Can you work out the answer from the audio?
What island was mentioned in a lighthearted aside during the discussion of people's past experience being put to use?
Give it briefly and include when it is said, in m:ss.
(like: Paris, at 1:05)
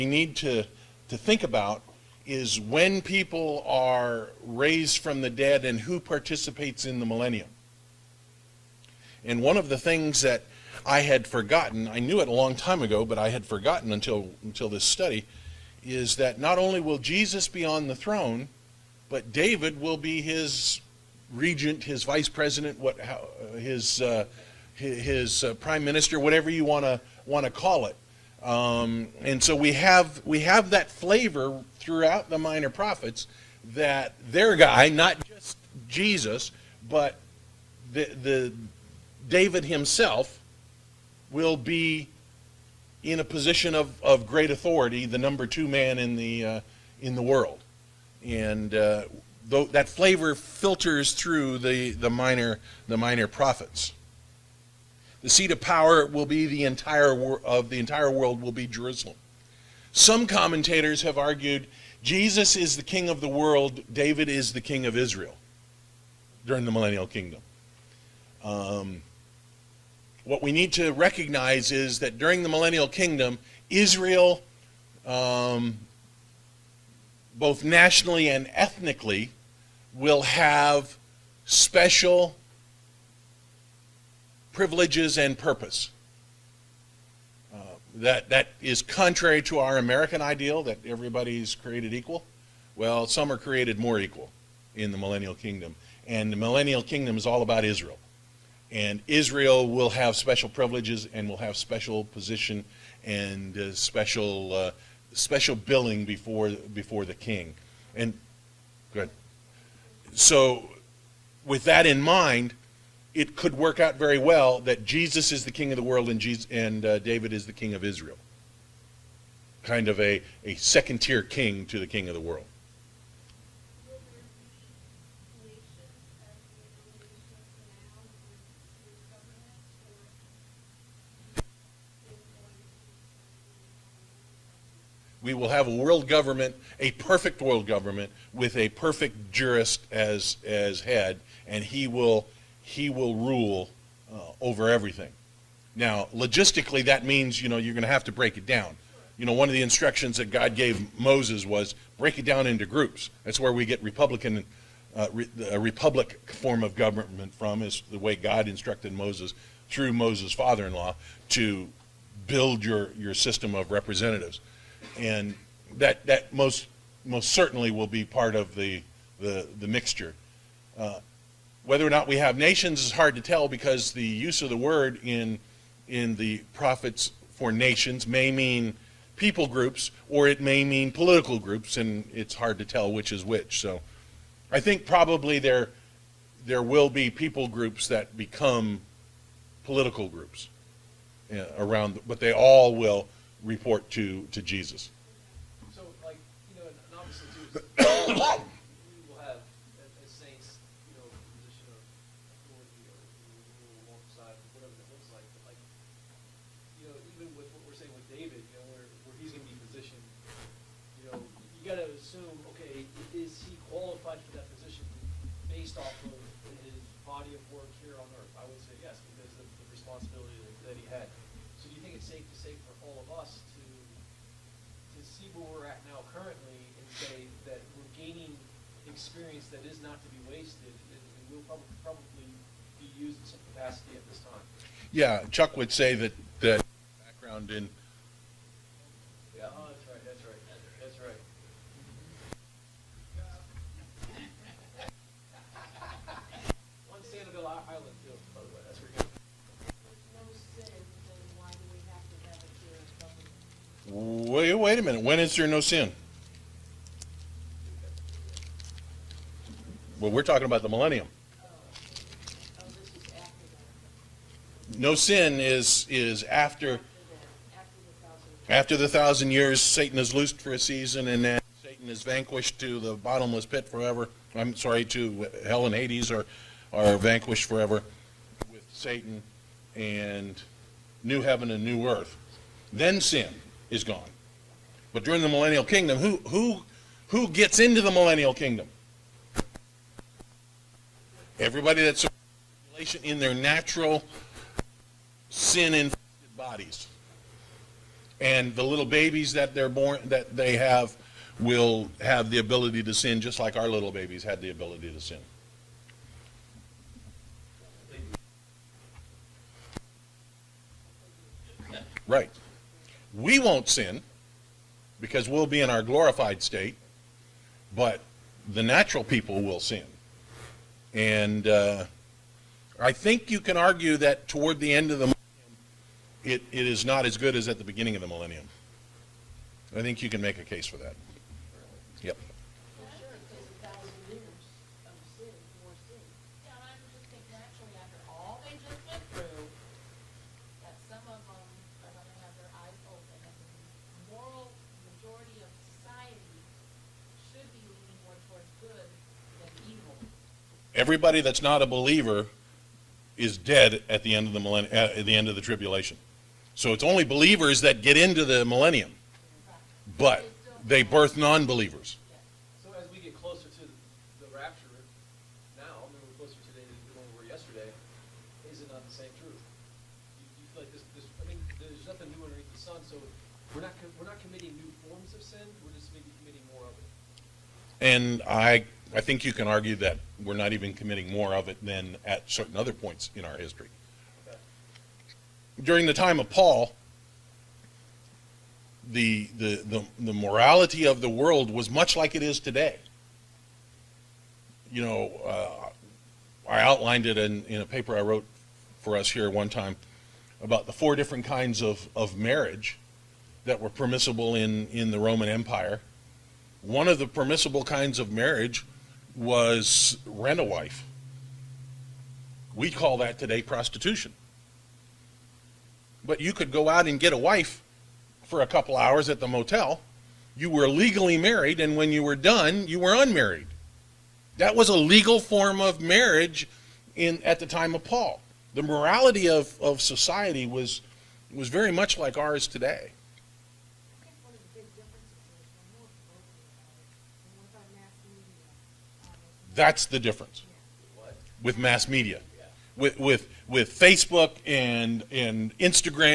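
Sanibel Island, at 4:07.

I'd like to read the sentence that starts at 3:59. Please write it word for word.
Yeah, oh, that's right, that's right, that's right.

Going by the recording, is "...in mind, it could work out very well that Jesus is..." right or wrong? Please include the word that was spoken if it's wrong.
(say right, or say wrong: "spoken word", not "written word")
right.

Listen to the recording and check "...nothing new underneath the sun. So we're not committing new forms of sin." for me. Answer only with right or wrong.
right.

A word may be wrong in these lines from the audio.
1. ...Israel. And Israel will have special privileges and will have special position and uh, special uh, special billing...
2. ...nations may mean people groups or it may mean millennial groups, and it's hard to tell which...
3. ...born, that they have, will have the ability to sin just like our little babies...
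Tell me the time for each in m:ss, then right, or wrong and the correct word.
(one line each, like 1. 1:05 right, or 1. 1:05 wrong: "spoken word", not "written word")
1. 1:37 right
2. 2:57 wrong: "political", not "millennial"
3. 4:59 right.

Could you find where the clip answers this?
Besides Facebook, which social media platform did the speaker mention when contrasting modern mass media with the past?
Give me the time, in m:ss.
7:25.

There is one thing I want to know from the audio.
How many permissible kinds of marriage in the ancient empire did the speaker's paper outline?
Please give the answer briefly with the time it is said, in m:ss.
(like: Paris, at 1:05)
4, at 6:40.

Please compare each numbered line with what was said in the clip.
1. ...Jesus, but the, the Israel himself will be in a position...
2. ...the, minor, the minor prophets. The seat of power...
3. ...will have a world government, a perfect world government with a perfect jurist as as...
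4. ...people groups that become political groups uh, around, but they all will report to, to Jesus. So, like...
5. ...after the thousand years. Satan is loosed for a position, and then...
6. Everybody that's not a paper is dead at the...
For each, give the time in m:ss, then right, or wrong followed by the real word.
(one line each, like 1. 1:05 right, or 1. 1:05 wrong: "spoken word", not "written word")
1. 0:35 wrong: "David", not "Israel"
2. 0:51 right
3. 2:15 right
4. 3:07 right
5. 4:28 wrong: "season", not "position"
6. 5:50 wrong: "believer", not "paper".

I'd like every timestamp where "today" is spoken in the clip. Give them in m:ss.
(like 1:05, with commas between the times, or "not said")
6:06, 6:32, 6:53, 7:12.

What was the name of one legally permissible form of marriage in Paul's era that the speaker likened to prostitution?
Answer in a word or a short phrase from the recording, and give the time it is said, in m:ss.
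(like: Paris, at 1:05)
rent a wife, at 6:50.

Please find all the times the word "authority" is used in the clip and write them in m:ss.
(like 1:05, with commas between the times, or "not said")
0:44.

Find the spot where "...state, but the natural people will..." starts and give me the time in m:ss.
5:16.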